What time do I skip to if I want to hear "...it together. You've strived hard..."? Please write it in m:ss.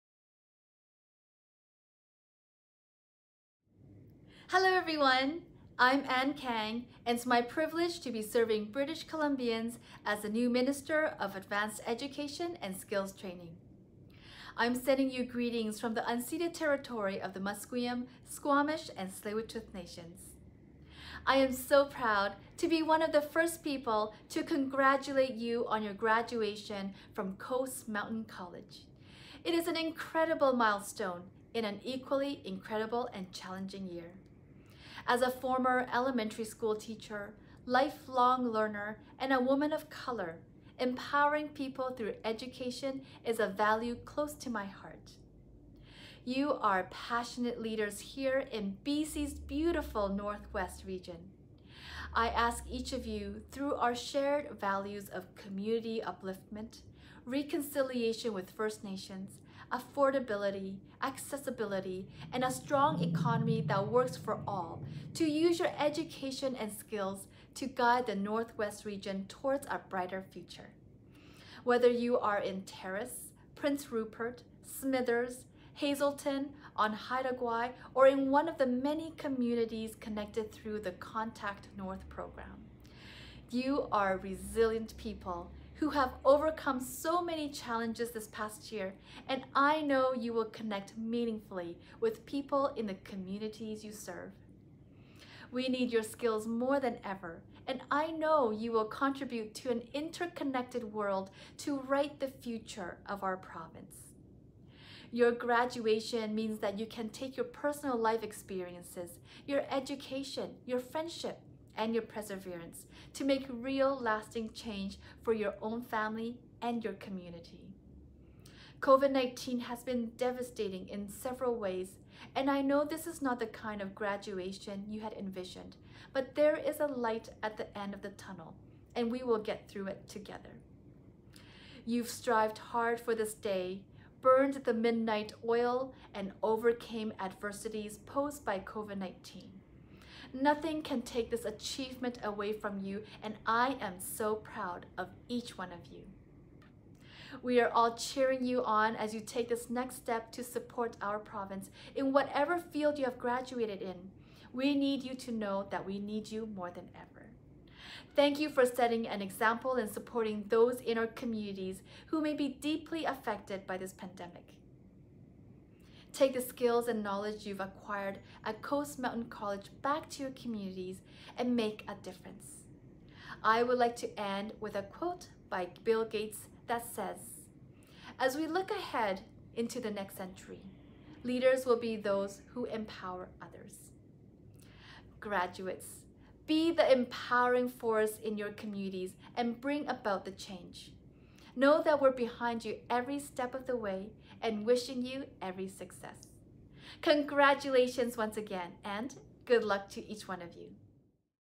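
2:09.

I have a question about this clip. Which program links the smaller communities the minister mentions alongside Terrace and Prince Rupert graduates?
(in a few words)
Contact North.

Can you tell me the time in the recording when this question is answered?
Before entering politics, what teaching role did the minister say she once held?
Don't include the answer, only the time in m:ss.
0:35.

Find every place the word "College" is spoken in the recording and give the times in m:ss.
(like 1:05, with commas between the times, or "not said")
0:28, 2:49.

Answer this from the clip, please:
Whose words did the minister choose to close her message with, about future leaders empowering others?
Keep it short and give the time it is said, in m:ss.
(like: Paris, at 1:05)
Bill Gates, at 2:55.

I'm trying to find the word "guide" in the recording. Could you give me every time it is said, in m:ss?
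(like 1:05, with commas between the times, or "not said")
1:07.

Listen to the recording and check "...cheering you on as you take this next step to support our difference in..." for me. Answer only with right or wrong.
wrong.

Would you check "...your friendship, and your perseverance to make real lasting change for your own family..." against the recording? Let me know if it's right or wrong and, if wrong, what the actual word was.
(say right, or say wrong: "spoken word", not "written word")
right.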